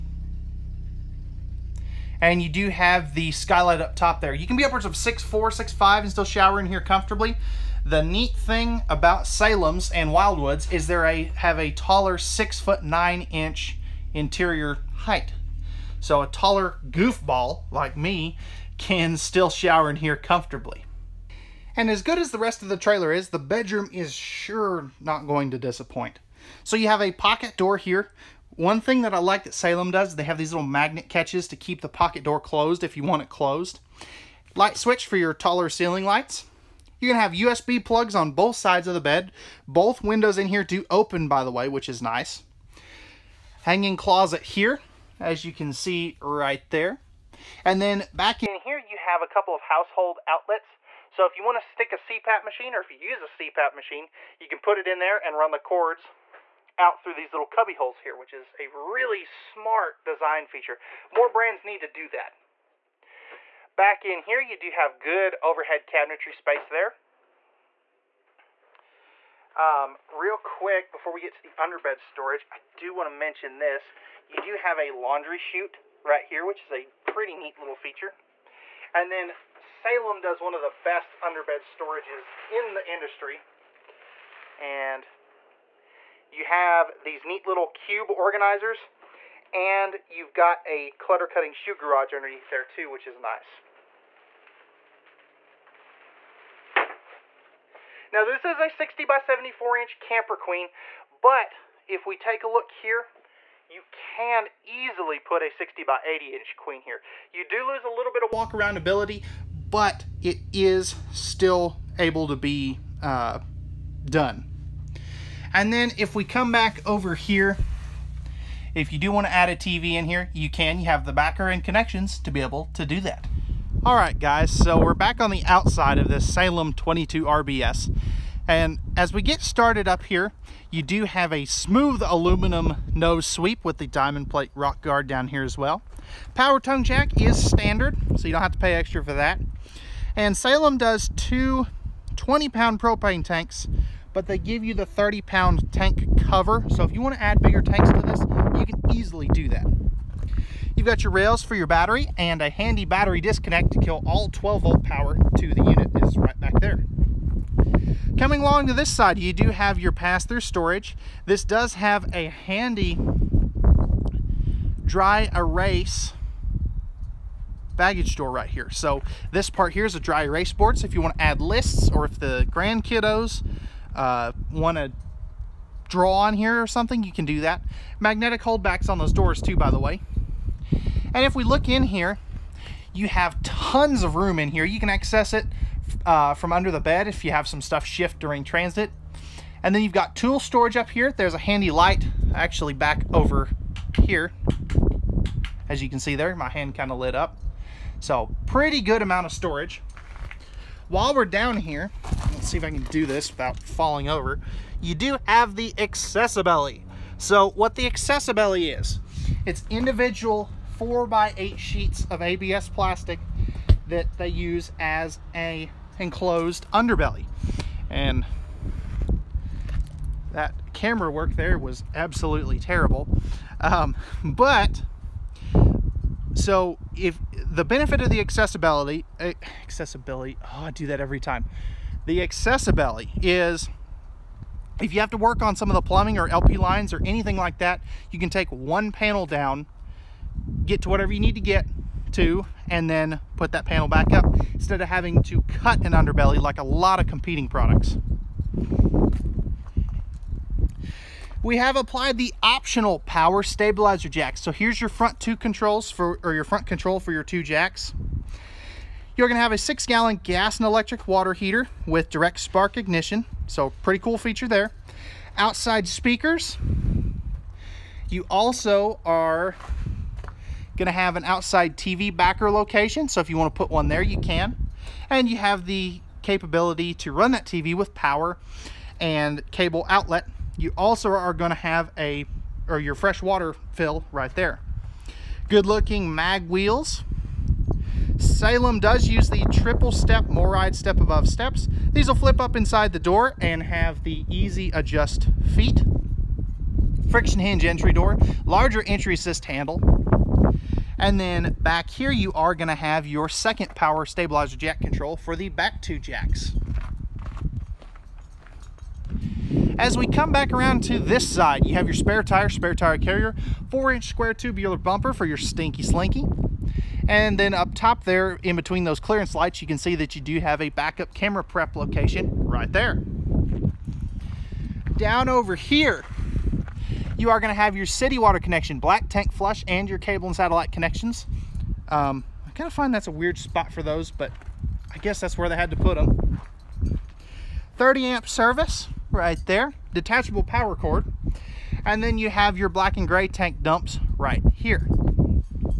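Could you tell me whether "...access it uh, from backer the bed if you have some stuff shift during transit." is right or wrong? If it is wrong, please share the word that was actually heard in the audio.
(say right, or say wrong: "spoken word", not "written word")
wrong: "under", not "backer".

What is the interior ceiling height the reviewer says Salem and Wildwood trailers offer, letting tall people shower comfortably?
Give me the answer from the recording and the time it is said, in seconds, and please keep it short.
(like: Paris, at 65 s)
6'9", at 12 s.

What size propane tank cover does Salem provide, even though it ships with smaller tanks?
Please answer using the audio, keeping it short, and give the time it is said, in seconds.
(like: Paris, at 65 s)
30 pound, at 144 s.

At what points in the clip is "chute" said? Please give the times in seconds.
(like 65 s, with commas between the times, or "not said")
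75 s.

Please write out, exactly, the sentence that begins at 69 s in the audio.
Um, real quick, before we get to the underbed storage, I do want to mention this.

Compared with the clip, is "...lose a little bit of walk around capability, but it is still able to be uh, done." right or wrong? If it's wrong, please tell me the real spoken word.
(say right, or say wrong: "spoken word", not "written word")
wrong: "ability", not "capability".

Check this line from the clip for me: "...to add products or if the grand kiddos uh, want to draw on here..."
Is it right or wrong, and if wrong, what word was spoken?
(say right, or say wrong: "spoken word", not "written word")
wrong: "lists", not "products".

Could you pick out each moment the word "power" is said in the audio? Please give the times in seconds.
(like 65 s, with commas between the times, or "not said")
136 s, 154 s, 253 s, 277 s, 303 s, 340 s.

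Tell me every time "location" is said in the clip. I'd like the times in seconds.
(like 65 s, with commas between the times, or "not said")
272 s, 321 s.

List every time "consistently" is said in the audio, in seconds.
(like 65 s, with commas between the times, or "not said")
not said.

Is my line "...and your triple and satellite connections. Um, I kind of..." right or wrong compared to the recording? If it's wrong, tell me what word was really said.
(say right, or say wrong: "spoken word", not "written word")
wrong: "cable", not "triple".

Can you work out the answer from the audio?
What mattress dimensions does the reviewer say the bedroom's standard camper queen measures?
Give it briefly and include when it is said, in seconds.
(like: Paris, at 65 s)
60 by 74 inch, at 98 s.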